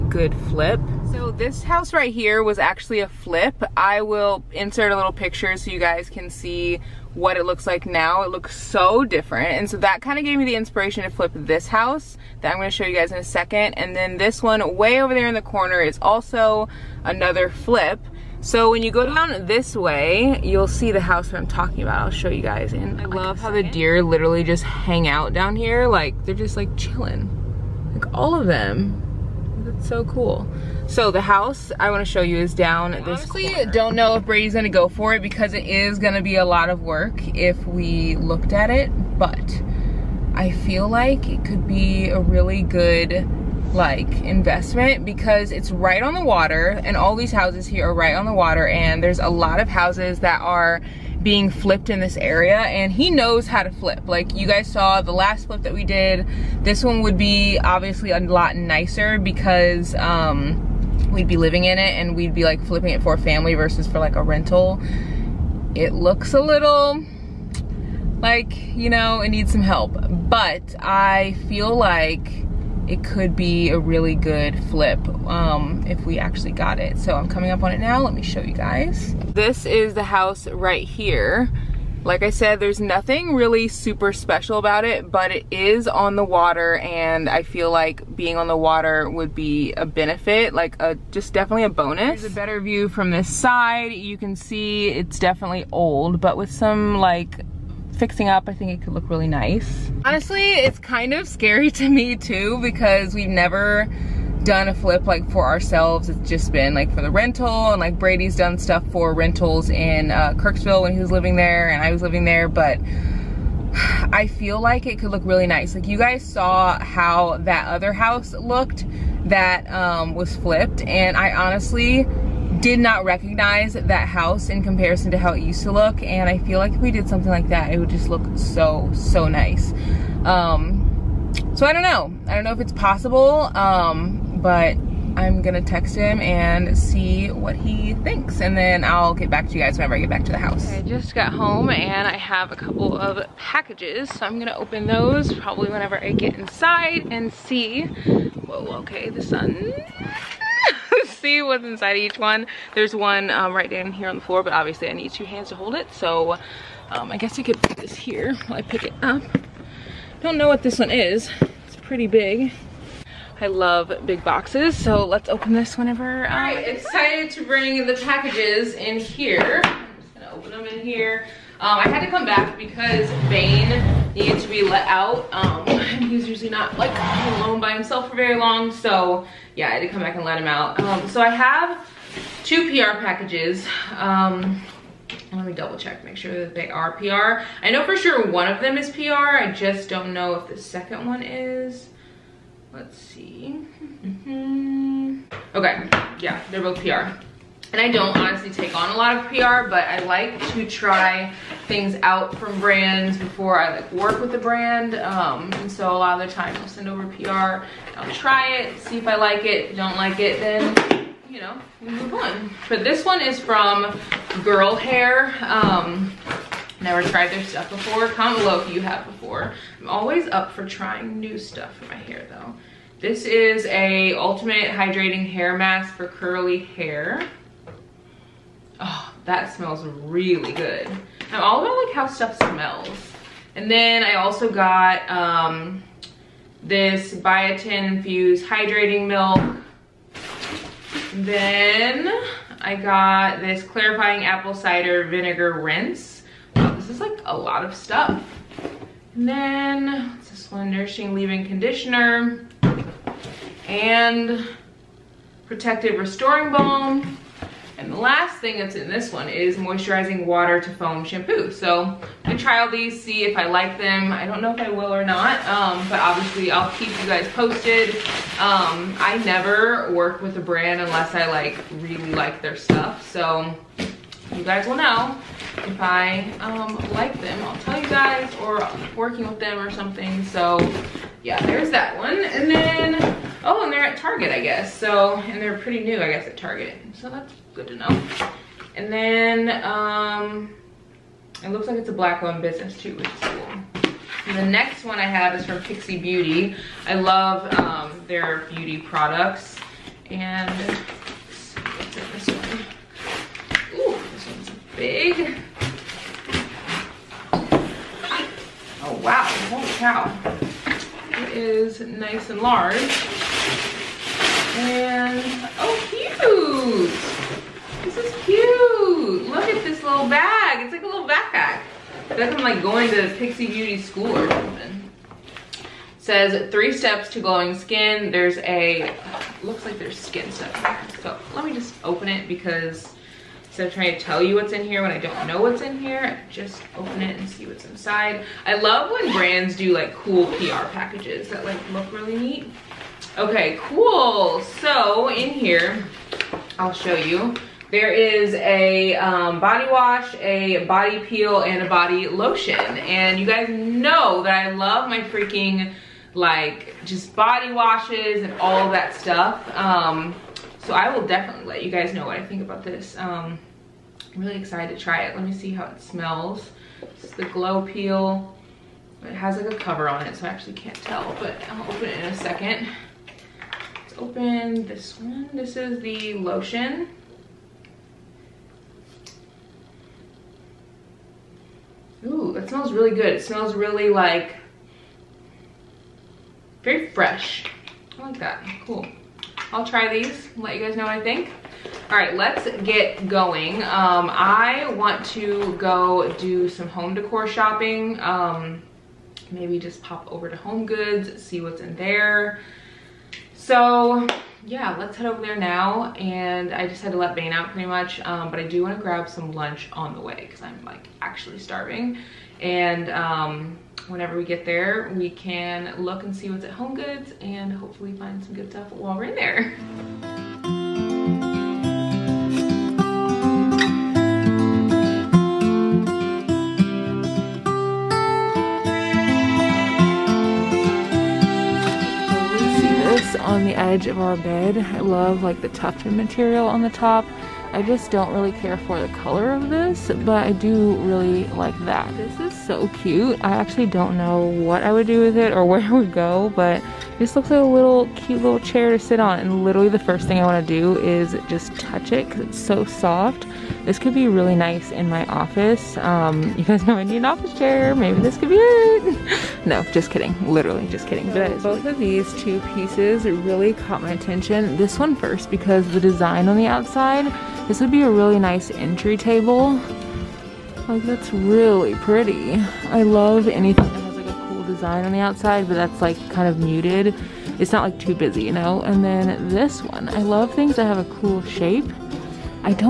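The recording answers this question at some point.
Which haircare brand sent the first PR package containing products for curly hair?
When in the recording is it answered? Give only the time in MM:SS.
03:34.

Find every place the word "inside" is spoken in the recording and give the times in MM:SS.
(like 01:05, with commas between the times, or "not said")
02:26, 02:31, 05:37.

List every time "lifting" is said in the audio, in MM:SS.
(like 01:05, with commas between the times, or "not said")
not said.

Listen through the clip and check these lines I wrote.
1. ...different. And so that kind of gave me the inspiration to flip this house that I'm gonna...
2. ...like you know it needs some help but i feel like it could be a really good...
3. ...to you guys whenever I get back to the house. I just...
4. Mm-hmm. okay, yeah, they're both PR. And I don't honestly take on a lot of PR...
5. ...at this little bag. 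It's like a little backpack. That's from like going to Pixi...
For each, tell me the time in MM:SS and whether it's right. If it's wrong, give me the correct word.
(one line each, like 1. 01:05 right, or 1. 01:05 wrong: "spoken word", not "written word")
1. 00:09 right
2. 01:08 right
3. 02:19 right
4. 03:14 right
5. 05:19 right.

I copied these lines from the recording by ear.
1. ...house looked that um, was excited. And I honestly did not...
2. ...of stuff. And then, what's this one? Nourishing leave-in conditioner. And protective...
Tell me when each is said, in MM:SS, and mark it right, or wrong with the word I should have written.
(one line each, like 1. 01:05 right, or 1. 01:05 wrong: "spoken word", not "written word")
1. 01:57 wrong: "flipped", not "excited"
2. 04:07 right.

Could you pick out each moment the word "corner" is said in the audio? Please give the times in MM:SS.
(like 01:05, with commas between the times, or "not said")
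00:15, 00:33.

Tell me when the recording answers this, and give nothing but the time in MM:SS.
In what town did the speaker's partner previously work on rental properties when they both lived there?
01:50.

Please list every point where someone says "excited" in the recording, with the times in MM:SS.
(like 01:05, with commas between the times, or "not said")
02:46, 06:04.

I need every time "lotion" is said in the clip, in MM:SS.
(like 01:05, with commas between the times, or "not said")
05:52, 06:16.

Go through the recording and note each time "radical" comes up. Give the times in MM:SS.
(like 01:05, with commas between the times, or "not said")
not said.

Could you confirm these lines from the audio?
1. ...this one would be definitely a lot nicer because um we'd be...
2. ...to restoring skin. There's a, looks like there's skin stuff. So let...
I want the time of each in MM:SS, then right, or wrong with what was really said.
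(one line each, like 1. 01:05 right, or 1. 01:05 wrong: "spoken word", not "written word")
1. 00:56 wrong: "obviously", not "definitely"
2. 05:27 wrong: "glowing", not "restoring".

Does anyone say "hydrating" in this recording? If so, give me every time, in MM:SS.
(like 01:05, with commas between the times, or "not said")
03:44, 03:58.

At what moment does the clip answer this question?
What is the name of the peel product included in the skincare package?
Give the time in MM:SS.
06:07.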